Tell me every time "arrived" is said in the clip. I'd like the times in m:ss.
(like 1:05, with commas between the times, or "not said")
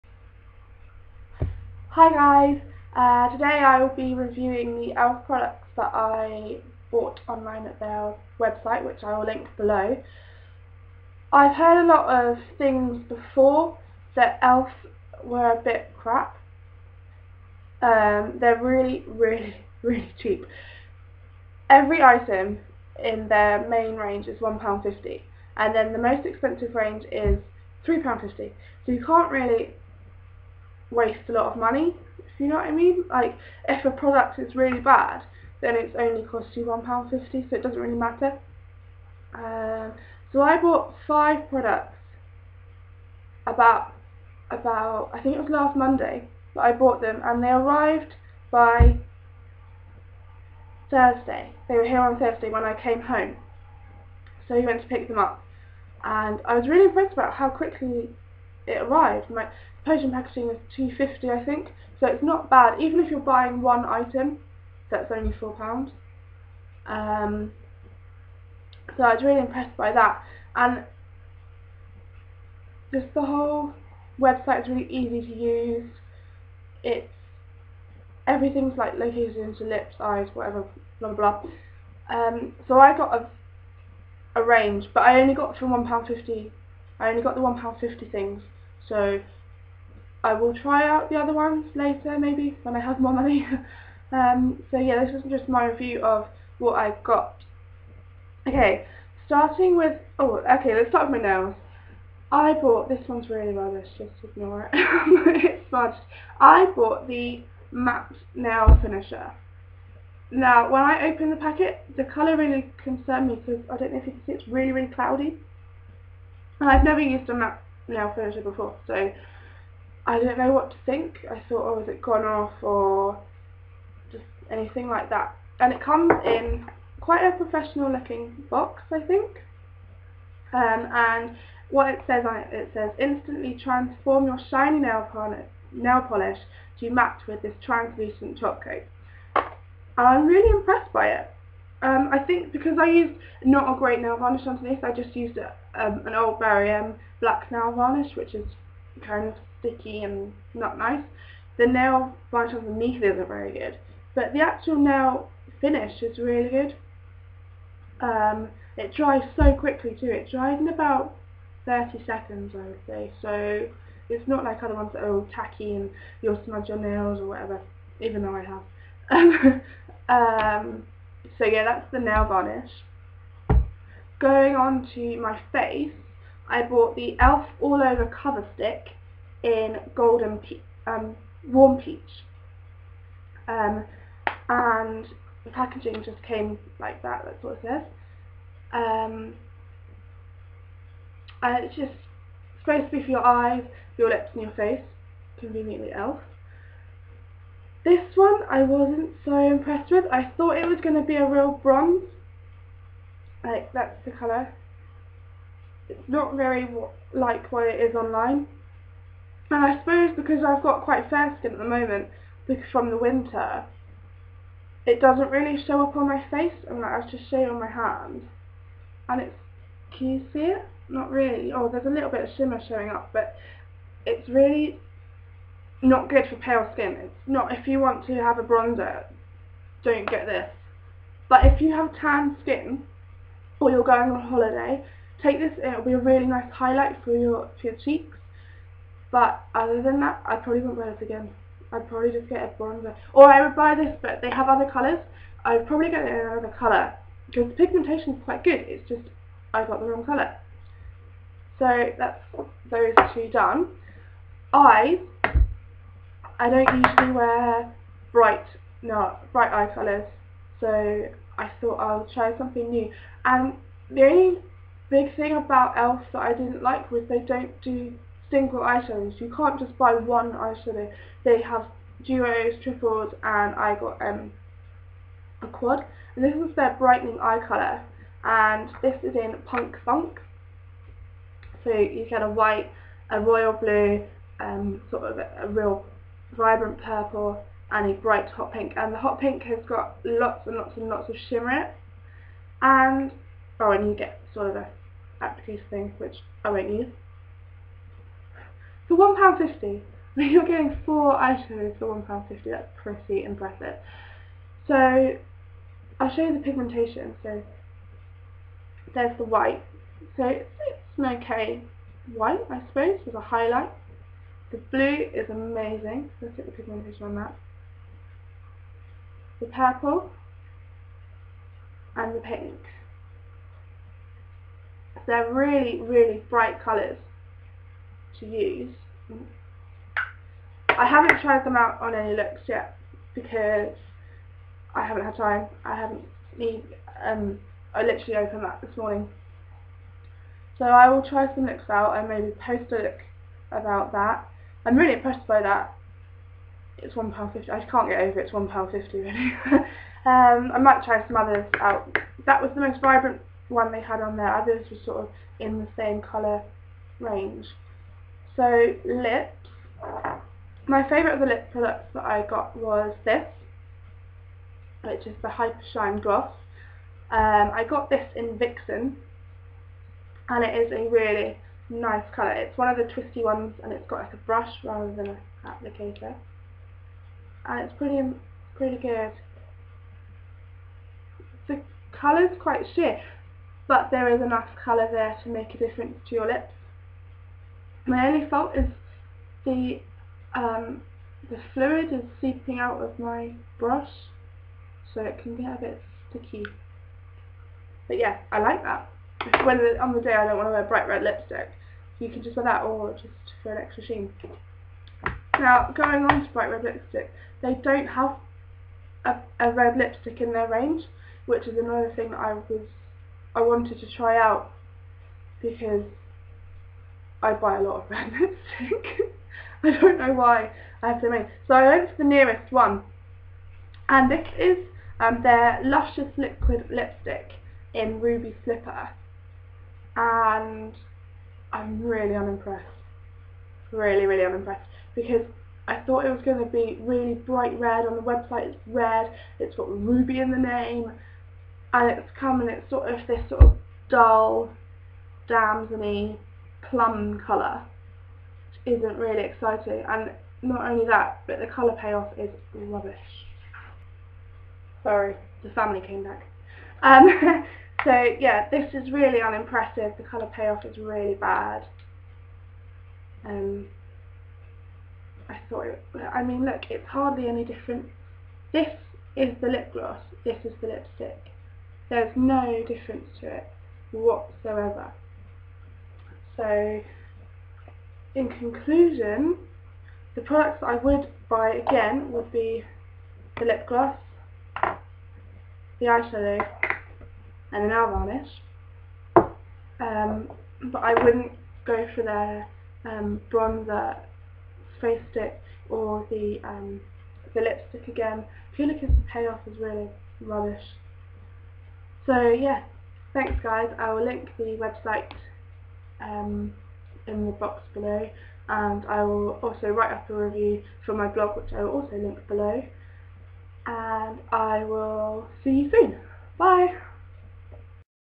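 0:47, 0:58.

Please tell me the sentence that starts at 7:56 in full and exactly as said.
So, in conclusion, the products I would buy again would be the lip gloss, the eyeshadow, and an hour on it.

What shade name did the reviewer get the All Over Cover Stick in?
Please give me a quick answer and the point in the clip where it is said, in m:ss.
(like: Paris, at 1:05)
Warm Peach, at 3:01.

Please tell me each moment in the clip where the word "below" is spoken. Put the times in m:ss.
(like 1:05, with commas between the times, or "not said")
0:09, 8:27, 8:32.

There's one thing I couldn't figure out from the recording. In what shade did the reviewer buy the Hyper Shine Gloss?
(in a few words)
Vixen.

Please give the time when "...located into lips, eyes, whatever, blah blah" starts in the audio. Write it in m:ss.
1:18.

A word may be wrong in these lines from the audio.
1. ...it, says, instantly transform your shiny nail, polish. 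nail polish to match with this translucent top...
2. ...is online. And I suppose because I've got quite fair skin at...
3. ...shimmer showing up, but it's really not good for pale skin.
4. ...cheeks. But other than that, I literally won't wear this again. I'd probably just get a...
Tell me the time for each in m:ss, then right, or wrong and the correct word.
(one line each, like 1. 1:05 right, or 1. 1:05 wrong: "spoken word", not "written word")
1. 2:12 right
2. 3:27 right
3. 3:42 right
4. 3:57 wrong: "probably", not "literally".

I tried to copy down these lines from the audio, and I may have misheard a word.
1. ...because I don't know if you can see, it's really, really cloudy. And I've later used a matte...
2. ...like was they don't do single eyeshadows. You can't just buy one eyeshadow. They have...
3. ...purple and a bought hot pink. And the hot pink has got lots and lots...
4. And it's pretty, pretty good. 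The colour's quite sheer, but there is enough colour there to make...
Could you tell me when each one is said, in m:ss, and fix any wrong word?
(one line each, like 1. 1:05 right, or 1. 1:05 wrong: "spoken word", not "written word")
1. 1:53 wrong: "never", not "later"
2. 4:26 right
3. 4:46 wrong: "bright", not "bought"
4. 6:17 right.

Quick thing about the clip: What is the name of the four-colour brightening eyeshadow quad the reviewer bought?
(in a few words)
Punk Funk.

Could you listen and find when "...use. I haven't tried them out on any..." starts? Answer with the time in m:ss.
5:28.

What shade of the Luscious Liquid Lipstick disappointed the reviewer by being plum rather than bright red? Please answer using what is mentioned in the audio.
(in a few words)
Ruby Slipper.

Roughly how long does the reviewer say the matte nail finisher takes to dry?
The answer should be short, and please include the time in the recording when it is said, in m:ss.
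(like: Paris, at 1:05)
30 seconds, at 2:41.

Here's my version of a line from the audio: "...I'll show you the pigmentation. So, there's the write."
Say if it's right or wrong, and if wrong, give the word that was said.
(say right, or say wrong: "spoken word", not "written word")
wrong: "white", not "write".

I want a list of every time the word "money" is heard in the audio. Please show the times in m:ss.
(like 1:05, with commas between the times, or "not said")
0:31, 1:33.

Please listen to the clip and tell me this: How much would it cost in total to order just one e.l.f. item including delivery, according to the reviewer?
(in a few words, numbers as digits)
four pounds.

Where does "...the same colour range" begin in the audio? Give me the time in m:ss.
5:55.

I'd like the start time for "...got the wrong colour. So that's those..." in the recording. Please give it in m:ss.
4:09.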